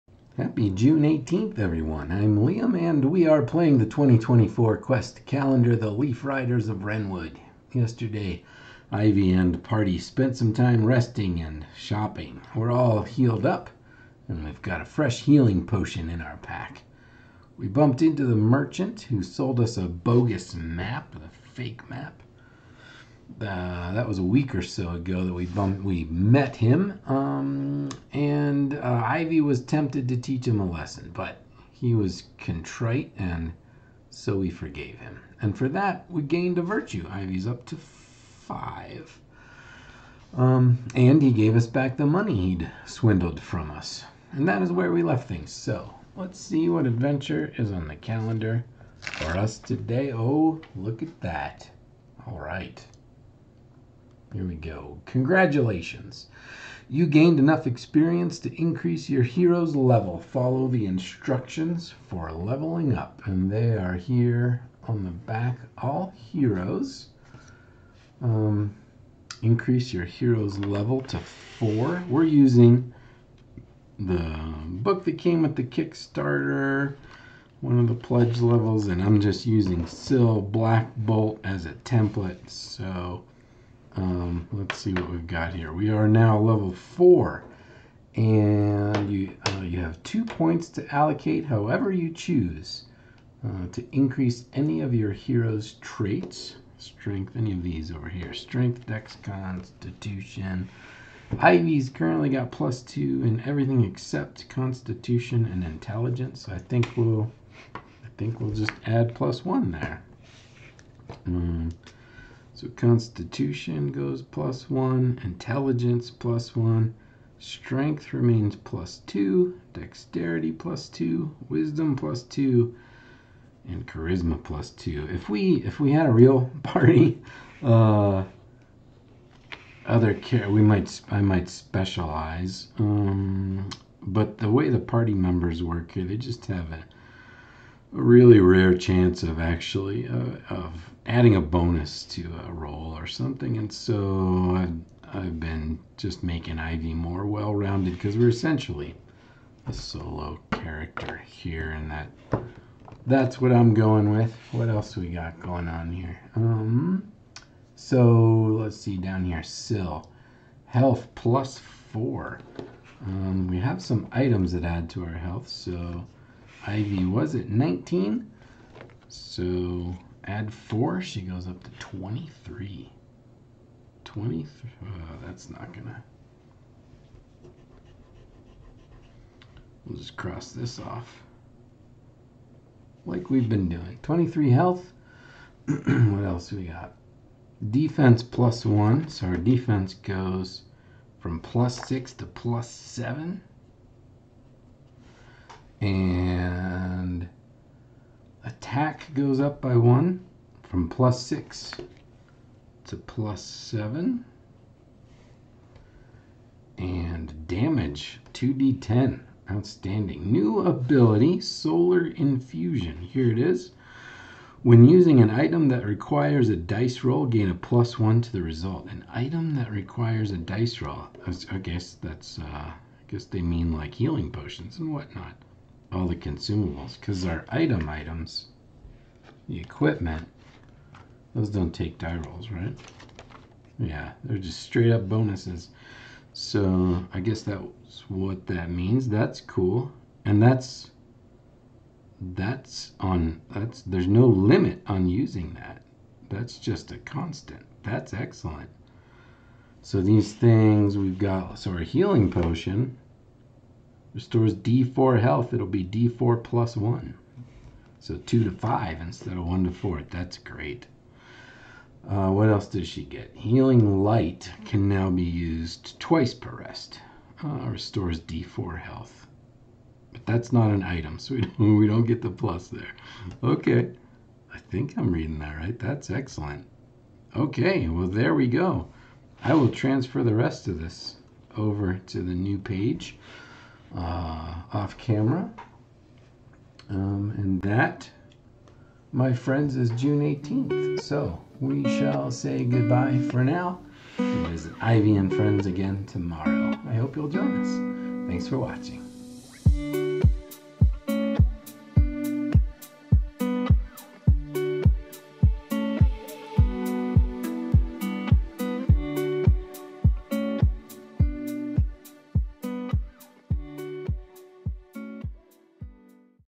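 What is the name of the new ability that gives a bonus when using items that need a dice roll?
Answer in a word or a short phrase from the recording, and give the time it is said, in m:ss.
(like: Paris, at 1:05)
Solar Infusion, at 3:31.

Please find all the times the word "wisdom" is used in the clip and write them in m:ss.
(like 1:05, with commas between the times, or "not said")
2:01.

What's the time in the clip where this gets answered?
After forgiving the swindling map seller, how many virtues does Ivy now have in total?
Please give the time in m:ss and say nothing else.
0:37.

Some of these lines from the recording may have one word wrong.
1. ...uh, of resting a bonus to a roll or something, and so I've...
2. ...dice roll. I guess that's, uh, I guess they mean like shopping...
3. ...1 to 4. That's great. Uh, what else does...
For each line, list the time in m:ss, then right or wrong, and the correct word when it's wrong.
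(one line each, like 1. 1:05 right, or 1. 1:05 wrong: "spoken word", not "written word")
1. 2:20 wrong: "adding", not "resting"
2. 3:40 wrong: "healing", not "shopping"
3. 4:19 right.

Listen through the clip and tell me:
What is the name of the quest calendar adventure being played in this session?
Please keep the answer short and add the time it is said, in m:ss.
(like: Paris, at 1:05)
The Leaf Riders of Wrenwood, at 0:05.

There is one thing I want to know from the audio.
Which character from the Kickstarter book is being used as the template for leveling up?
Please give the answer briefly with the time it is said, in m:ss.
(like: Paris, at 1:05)
Sill Black Bolt, at 1:19.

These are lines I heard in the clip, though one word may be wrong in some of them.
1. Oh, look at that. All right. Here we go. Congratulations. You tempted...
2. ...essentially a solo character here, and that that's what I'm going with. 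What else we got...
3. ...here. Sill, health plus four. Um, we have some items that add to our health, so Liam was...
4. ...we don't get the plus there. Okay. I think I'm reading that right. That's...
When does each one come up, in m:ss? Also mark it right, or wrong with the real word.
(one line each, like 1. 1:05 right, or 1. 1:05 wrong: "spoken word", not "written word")
1. 0:50 wrong: "gained", not "tempted"
2. 2:28 right
3. 2:39 wrong: "Ivy", not "Liam"
4. 4:31 right.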